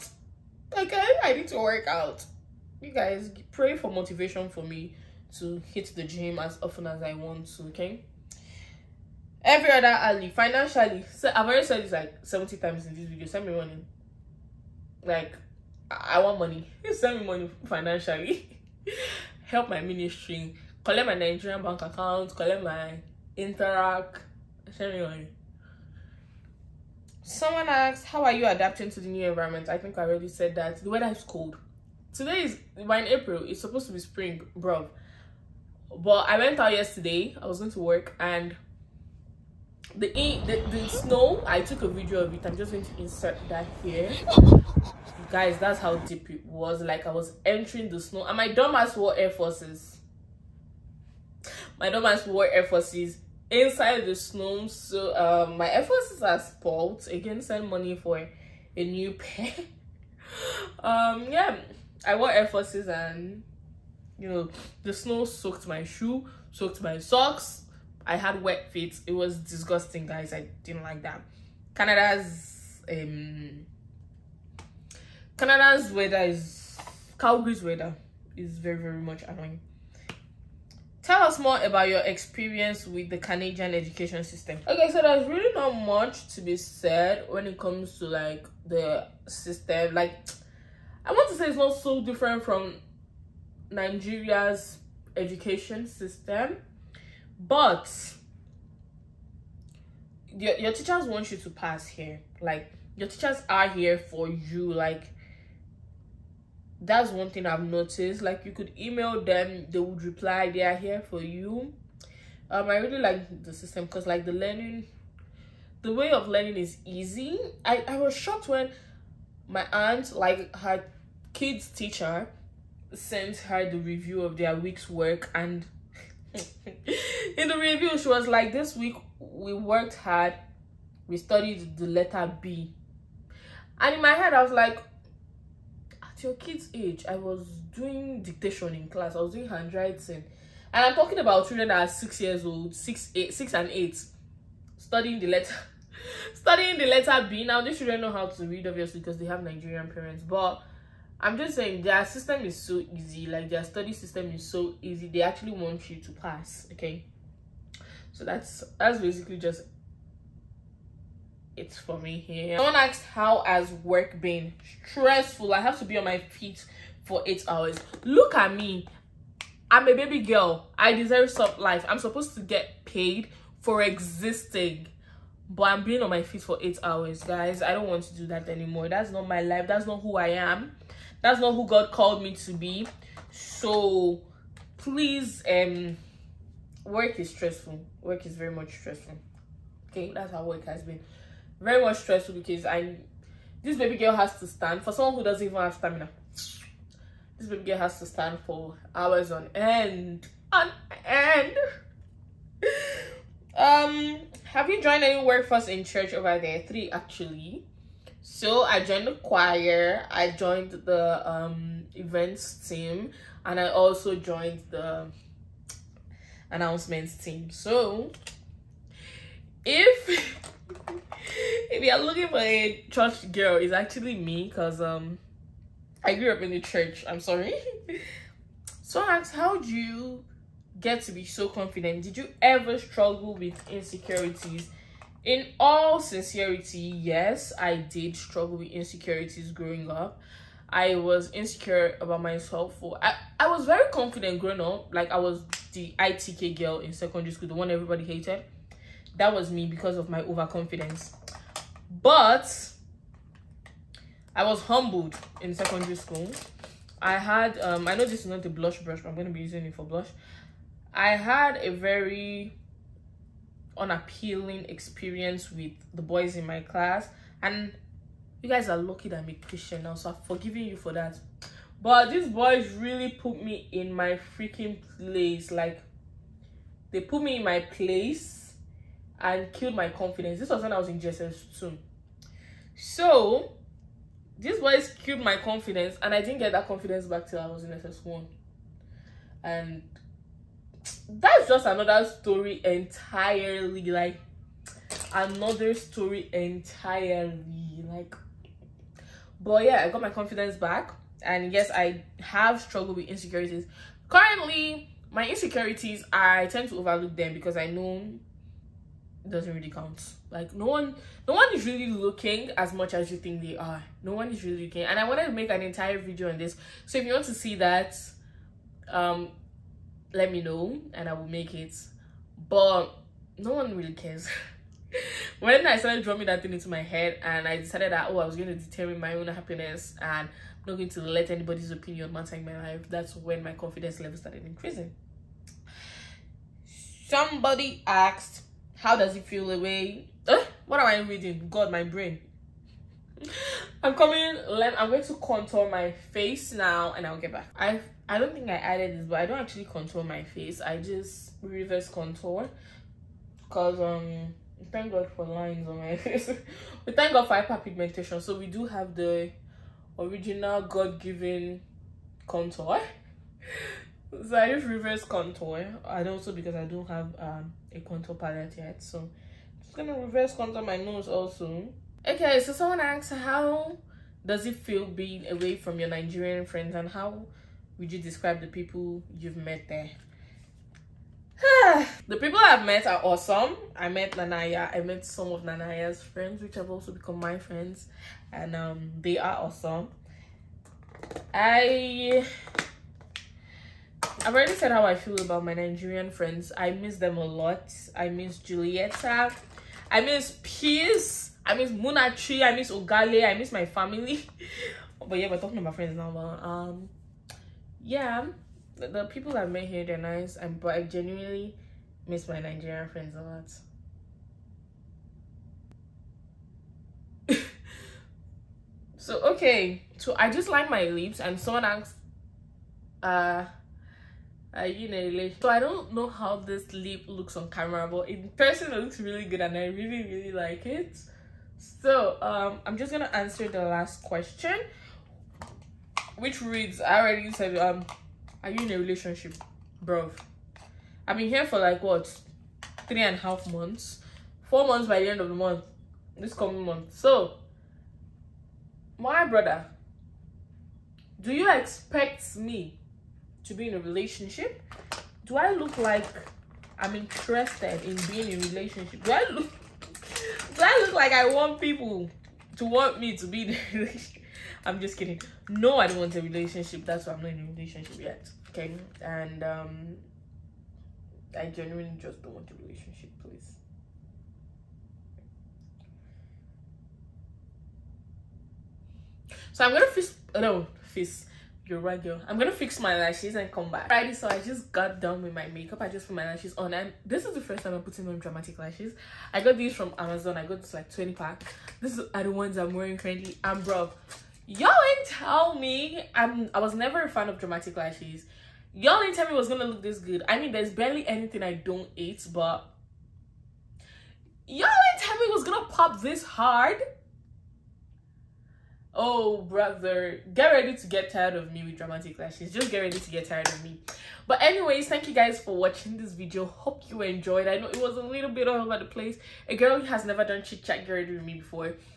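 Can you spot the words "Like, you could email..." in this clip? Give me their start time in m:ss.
1:48.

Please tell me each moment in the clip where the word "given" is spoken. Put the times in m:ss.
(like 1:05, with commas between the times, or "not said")
6:00.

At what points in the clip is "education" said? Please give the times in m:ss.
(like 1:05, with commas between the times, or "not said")
1:23, 1:35.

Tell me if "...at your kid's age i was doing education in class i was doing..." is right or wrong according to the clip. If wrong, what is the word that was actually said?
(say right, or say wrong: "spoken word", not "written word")
wrong: "dictation", not "education".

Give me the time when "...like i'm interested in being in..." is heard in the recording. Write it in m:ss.
7:35.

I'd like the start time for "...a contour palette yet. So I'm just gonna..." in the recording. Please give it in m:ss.
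6:07.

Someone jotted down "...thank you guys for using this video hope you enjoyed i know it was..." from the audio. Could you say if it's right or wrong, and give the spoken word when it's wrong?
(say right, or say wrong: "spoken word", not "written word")
wrong: "watching", not "using".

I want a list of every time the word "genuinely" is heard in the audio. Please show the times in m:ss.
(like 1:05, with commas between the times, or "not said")
6:50, 7:51.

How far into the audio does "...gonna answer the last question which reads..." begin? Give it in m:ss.
7:12.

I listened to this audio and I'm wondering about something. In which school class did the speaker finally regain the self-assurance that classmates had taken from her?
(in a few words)
SS1.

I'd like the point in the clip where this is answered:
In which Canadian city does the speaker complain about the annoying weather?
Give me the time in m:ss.
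1:17.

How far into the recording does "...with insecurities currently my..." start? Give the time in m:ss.
5:02.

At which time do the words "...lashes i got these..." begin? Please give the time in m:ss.
8:08.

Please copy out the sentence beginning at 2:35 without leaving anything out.
They actually want you to pass, okay?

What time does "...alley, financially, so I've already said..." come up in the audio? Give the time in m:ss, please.
0:09.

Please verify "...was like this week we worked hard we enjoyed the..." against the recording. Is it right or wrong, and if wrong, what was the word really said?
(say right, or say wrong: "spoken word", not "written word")
wrong: "studied", not "enjoyed".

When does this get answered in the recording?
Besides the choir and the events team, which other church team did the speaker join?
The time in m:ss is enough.
3:36.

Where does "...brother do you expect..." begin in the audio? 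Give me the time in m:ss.
7:29.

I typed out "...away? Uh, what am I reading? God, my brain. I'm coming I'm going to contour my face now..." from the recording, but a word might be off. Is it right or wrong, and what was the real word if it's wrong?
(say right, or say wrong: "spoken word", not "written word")
right.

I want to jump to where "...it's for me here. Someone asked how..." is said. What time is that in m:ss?
2:41.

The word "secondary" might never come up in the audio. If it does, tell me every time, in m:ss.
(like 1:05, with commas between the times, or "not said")
4:06, 4:15.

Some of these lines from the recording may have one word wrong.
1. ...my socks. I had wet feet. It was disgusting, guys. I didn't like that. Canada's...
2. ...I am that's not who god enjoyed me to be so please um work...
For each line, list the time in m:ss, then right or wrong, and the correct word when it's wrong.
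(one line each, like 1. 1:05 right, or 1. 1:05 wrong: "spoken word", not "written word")
1. 1:06 right
2. 3:00 wrong: "called", not "enjoyed".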